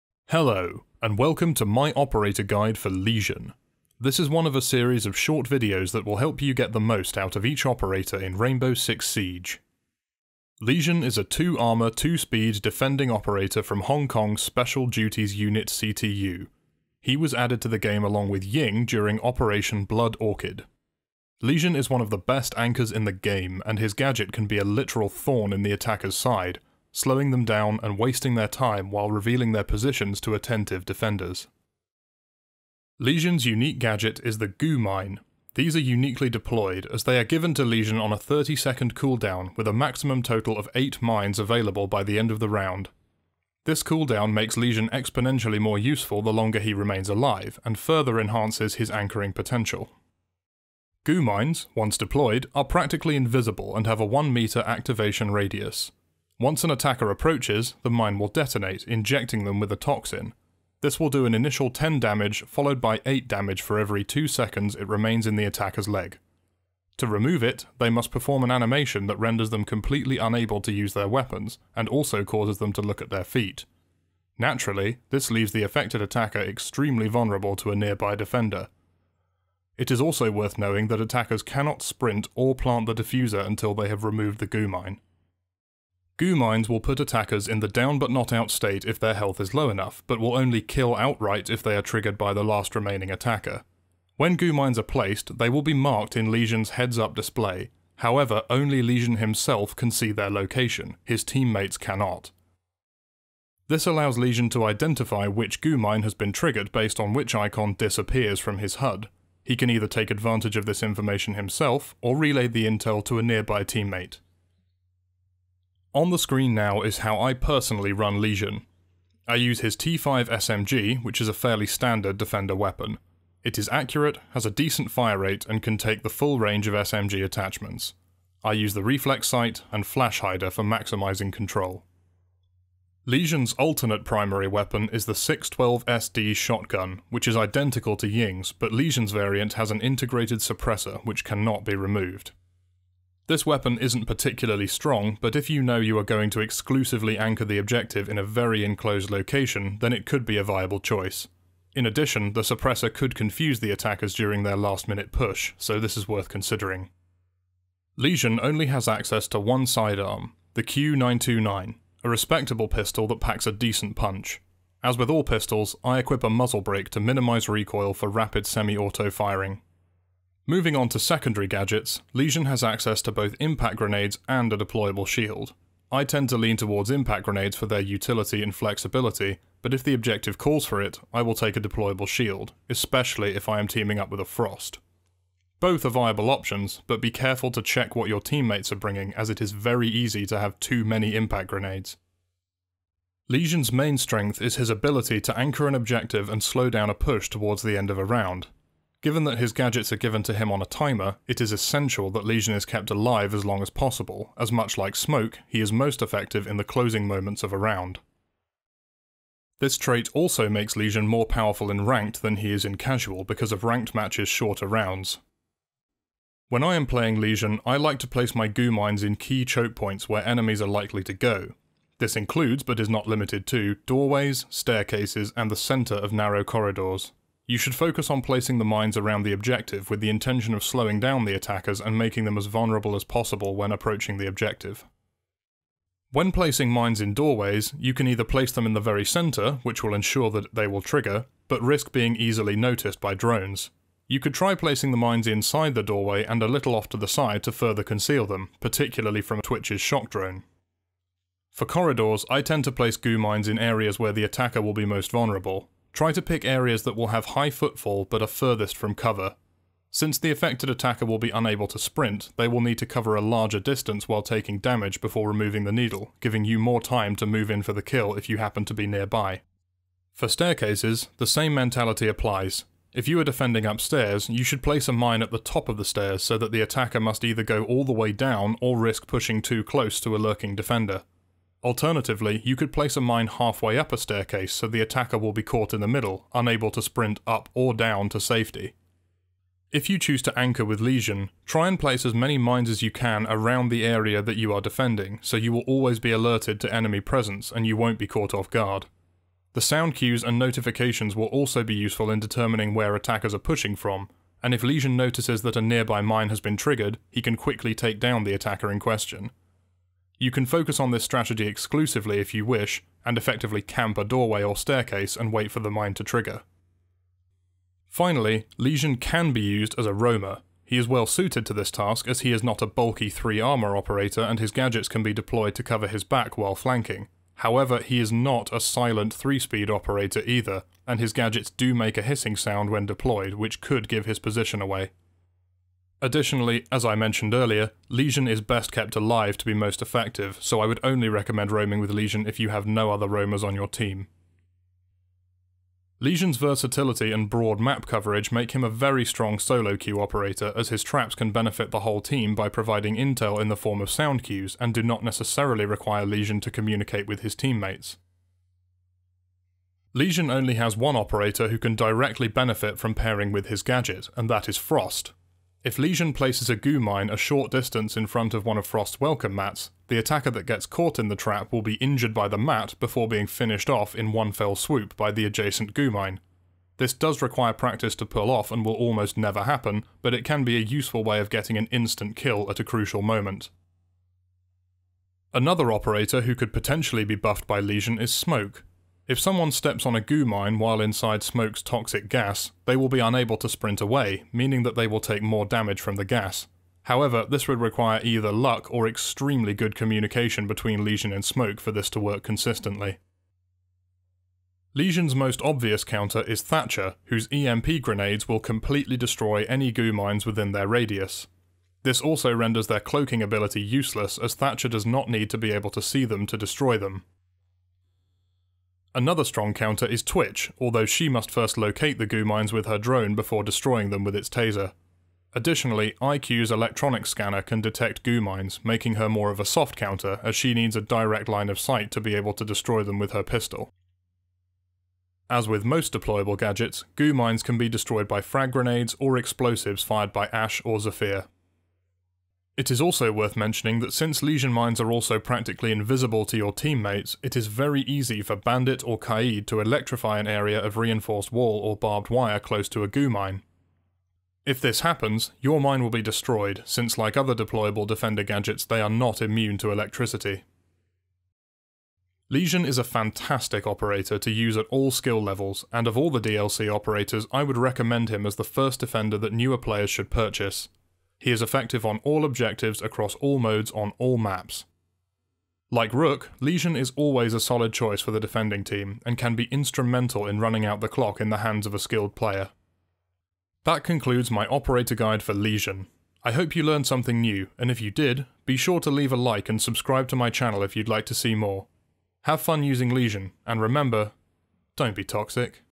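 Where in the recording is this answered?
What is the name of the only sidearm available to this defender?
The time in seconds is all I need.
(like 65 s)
160 s.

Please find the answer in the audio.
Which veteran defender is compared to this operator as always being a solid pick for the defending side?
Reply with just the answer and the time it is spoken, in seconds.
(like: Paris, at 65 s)
Rook, at 475 s.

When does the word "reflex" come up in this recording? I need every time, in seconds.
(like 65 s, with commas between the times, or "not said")
128 s.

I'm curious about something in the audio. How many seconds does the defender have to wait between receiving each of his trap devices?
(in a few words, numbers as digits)
30.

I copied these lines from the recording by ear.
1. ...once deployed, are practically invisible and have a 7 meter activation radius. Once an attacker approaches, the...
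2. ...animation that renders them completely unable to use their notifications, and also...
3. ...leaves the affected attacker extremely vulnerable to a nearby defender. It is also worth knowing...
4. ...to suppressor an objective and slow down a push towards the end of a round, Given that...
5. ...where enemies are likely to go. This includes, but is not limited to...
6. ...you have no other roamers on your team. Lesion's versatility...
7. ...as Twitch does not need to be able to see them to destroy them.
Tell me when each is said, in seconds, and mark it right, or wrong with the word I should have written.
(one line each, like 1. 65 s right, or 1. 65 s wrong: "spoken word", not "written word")
1. 51 s wrong: "1", not "7"
2. 68 s wrong: "weapons", not "notifications"
3. 75 s right
4. 195 s wrong: "anchor", not "suppressor"
5. 220 s right
6. 342 s right
7. 414 s wrong: "Thatcher", not "Twitch".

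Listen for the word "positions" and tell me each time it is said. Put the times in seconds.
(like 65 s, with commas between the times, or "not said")
29 s, 334 s.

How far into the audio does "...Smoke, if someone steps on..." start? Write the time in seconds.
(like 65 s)
388 s.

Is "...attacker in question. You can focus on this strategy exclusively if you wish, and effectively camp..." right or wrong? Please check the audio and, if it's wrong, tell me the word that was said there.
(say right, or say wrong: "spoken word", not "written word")
right.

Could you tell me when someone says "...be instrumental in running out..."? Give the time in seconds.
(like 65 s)
479 s.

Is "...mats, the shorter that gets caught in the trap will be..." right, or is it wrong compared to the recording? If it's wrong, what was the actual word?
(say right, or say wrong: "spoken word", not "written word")
wrong: "attacker", not "shorter".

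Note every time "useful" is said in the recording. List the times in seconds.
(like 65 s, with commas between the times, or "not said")
45 s, 301 s, 380 s.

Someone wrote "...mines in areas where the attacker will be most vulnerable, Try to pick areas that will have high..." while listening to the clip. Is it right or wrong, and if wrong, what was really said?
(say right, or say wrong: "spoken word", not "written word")
right.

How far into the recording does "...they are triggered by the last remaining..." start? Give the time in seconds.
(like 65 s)
91 s.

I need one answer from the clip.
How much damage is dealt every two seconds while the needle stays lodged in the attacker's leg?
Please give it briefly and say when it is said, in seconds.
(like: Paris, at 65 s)
8, at 63 s.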